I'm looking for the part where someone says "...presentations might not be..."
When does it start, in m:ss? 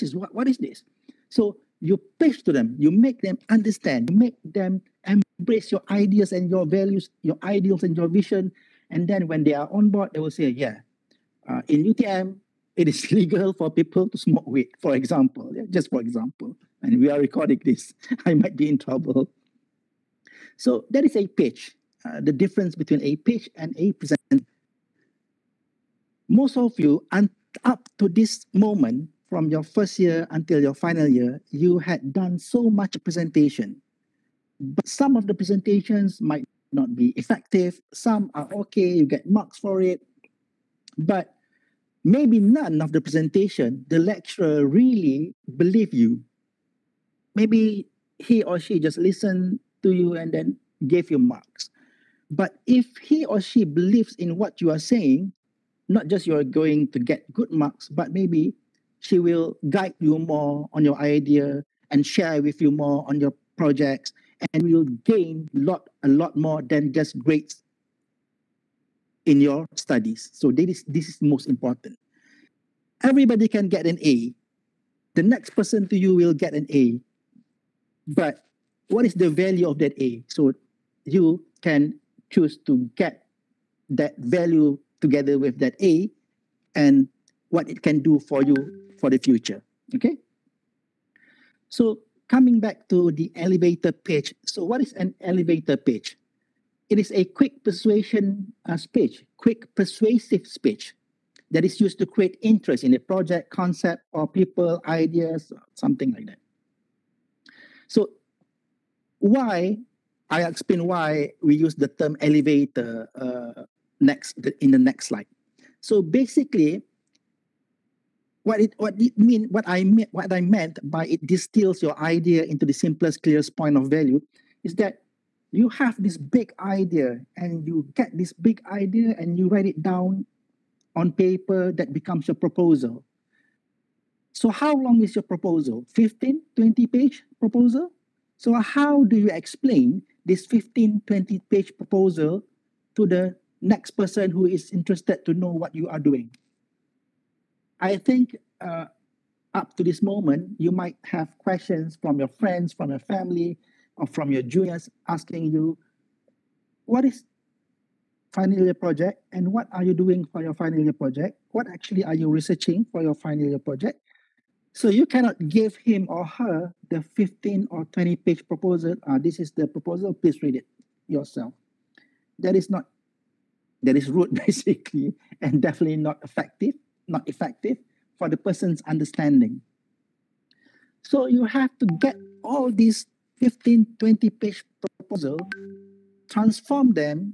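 0:35.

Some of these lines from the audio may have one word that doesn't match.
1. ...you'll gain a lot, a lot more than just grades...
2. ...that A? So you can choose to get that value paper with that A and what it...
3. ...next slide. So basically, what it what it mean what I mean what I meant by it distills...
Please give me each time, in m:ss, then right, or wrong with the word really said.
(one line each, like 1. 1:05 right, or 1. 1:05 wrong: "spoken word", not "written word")
1. 1:04 right
2. 1:19 wrong: "together", not "paper"
3. 1:54 right.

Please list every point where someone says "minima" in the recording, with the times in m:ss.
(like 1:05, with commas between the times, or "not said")
not said.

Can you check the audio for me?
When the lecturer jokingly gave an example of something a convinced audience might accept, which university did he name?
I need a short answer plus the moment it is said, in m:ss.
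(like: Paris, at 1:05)
UTM, at 0:11.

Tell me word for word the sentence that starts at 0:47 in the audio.
Maybe he or she just listened to you and then gave you marks.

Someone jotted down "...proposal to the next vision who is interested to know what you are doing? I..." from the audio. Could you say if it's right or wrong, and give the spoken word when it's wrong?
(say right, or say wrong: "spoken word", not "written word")
wrong: "person", not "vision".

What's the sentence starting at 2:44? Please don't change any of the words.
So you cannot give him or her the 15 or 20 page proposal.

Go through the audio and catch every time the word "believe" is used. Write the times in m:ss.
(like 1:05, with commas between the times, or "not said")
0:45, 0:53.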